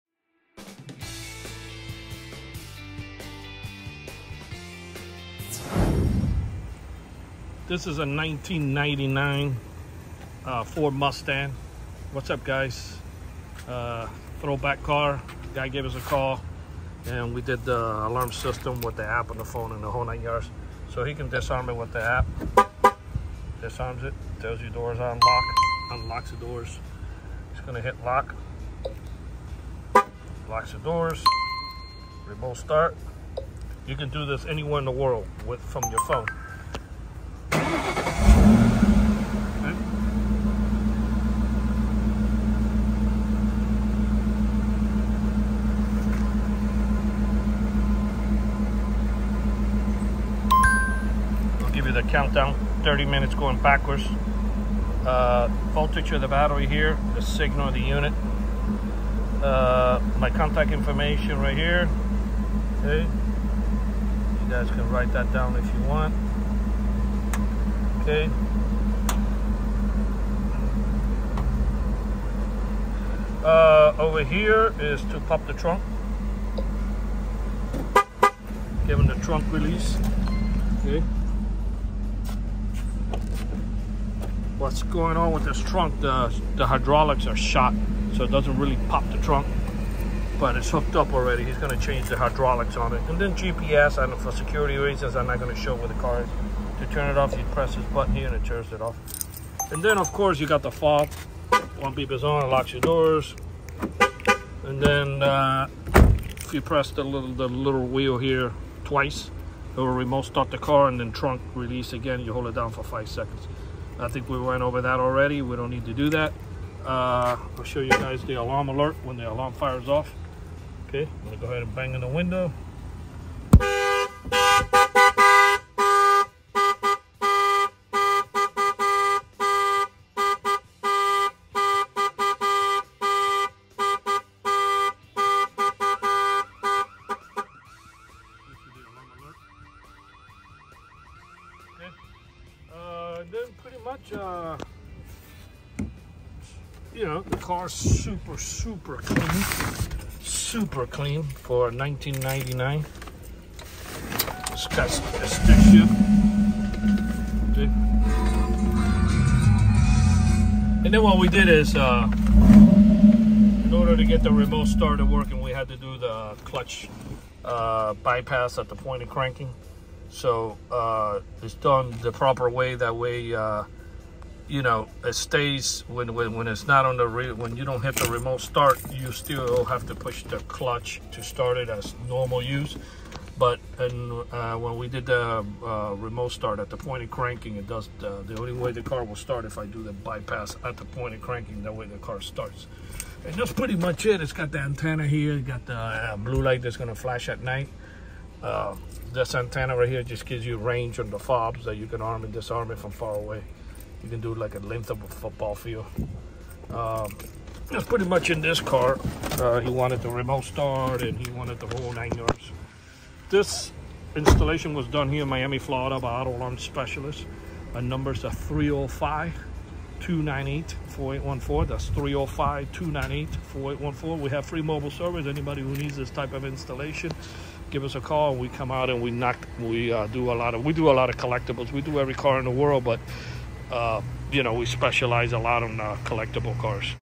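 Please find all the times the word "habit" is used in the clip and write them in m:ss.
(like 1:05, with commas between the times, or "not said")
not said.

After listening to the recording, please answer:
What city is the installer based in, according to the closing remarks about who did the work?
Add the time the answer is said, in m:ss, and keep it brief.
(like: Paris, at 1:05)
Miami, Florida, at 3:35.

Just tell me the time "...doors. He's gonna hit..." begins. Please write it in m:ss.
0:26.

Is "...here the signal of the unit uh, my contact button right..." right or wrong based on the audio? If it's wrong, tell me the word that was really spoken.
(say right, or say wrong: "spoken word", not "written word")
wrong: "information", not "button".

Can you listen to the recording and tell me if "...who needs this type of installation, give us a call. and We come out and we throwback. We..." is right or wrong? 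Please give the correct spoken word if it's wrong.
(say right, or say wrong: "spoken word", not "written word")
wrong: "knock", not "throwback".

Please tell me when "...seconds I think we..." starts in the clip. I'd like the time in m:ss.
1:53.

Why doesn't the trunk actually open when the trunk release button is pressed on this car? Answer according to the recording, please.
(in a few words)
The hydraulics are shot.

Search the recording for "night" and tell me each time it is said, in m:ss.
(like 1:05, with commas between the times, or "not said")
3:17.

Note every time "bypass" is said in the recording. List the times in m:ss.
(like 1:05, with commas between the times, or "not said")
2:47, 3:09.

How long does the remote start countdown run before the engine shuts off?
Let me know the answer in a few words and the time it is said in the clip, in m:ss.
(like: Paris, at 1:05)
30 minutes, at 0:52.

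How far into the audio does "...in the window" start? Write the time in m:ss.
2:01.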